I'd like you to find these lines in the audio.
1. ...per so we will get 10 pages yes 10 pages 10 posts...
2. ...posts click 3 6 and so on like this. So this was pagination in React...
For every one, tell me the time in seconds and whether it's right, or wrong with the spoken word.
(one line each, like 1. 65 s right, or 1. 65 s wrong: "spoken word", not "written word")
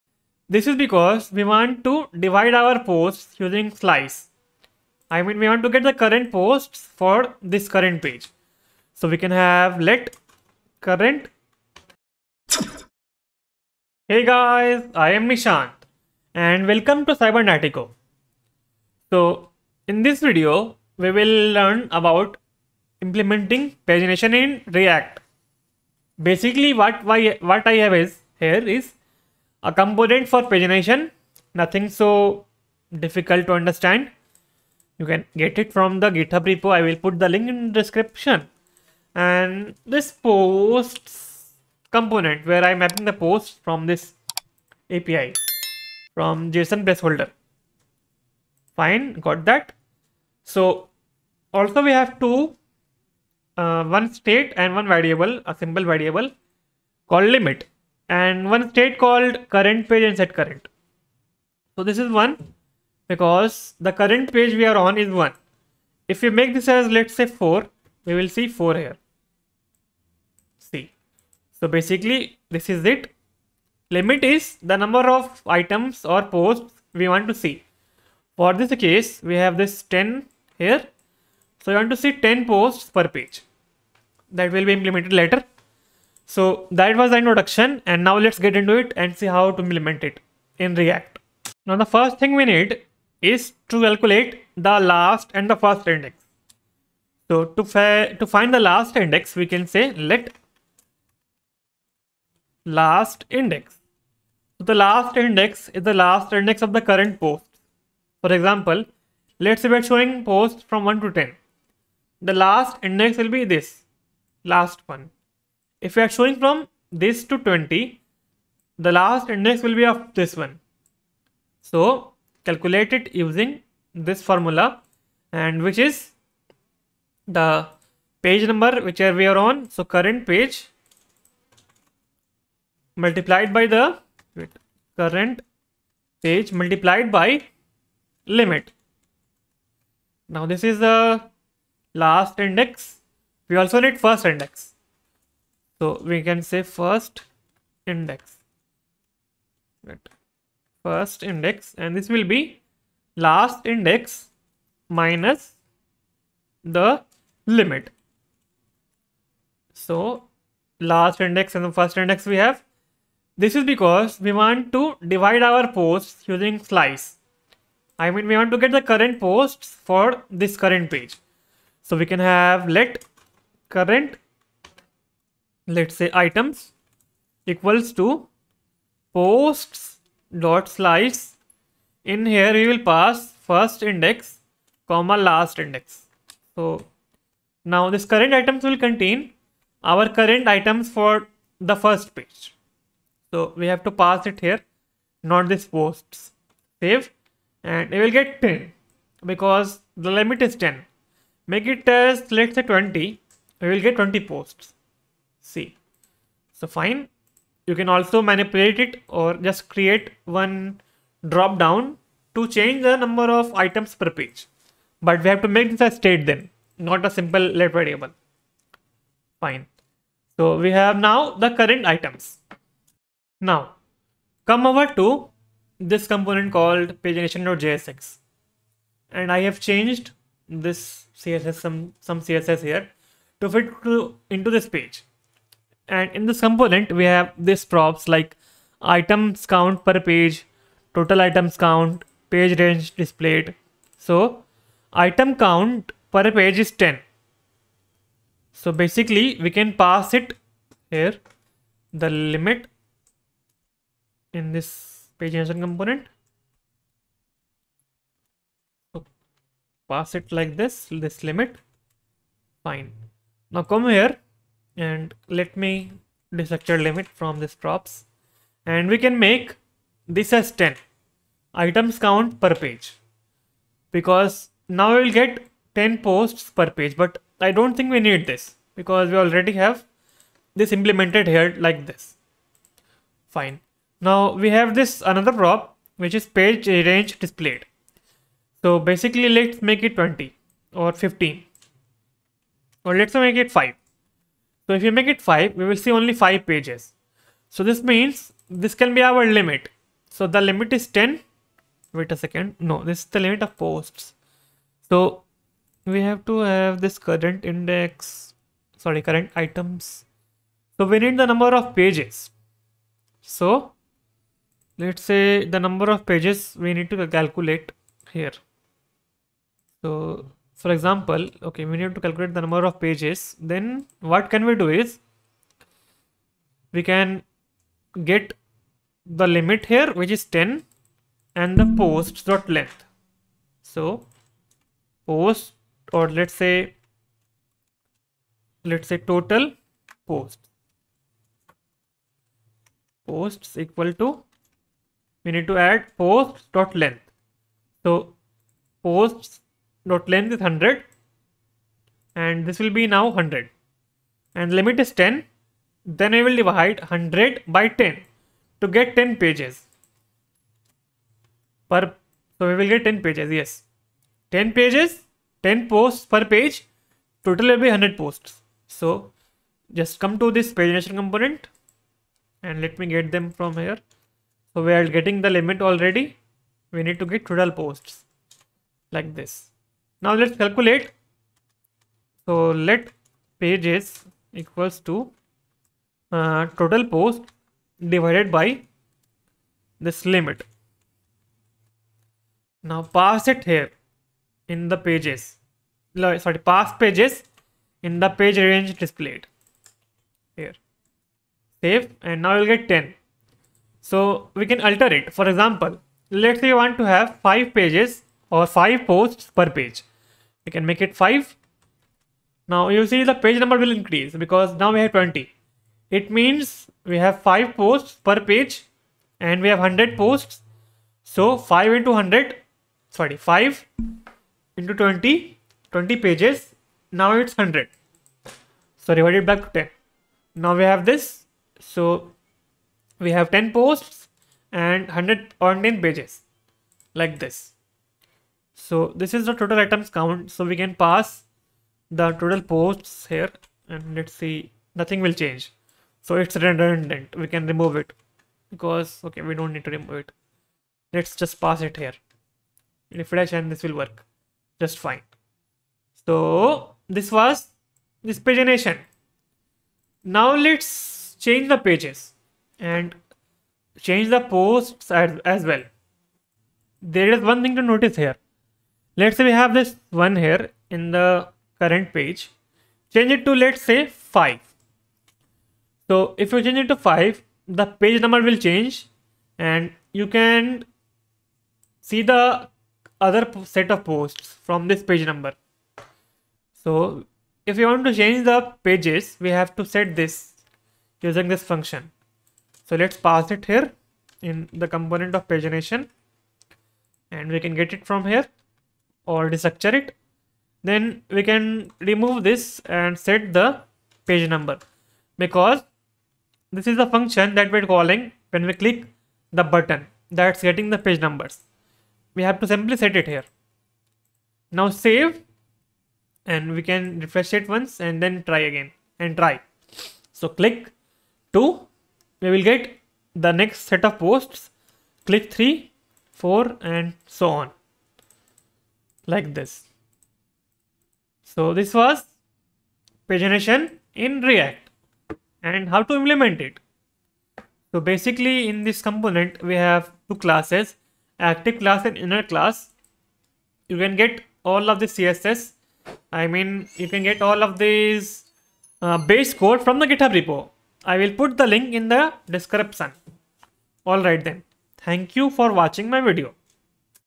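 1. 361 s right
2. 523 s wrong: "4", not "6".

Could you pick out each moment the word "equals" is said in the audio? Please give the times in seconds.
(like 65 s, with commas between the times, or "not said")
177 s, 343 s, 384 s.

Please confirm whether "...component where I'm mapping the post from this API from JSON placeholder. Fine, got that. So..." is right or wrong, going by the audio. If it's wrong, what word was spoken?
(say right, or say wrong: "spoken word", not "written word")
right.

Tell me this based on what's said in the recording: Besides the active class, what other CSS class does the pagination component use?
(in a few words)
inner class.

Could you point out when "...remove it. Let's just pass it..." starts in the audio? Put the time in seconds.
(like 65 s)
449 s.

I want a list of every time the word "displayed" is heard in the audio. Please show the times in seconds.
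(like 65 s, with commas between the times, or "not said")
242 s, 287 s, 398 s.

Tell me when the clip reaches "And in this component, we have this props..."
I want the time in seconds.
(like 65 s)
235 s.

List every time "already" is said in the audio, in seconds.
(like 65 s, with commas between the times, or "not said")
279 s, 375 s.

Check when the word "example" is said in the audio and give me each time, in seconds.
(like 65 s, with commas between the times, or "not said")
108 s, 320 s, 405 s.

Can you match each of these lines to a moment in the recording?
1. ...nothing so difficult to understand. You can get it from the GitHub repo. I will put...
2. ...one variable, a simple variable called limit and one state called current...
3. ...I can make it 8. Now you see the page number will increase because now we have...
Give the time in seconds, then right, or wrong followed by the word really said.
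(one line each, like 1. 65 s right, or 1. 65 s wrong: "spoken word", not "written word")
1. 31 s right
2. 54 s right
3. 410 s wrong: "5", not "8".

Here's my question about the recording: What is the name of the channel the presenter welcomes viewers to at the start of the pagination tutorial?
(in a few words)
Cybernatico.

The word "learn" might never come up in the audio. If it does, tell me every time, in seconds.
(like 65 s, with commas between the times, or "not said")
21 s.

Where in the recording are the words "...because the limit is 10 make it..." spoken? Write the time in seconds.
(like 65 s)
199 s.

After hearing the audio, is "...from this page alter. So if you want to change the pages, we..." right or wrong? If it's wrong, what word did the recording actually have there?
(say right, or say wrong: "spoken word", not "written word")
wrong: "number", not "alter".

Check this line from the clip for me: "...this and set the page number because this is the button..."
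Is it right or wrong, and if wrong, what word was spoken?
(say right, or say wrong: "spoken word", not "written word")
wrong: "function", not "button".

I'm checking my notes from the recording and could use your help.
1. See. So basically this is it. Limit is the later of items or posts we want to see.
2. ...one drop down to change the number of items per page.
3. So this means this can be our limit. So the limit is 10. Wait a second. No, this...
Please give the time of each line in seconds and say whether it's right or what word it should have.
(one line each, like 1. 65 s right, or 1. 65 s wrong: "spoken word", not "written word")
1. 70 s wrong: "number", not "later"
2. 210 s right
3. 297 s right.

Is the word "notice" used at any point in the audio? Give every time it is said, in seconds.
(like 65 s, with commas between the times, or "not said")
467 s.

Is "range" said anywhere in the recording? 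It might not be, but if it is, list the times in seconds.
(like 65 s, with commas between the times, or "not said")
242 s, 286 s, 398 s.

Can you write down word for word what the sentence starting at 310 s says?
So we need the number of pages.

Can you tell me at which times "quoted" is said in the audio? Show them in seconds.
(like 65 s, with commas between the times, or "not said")
not said.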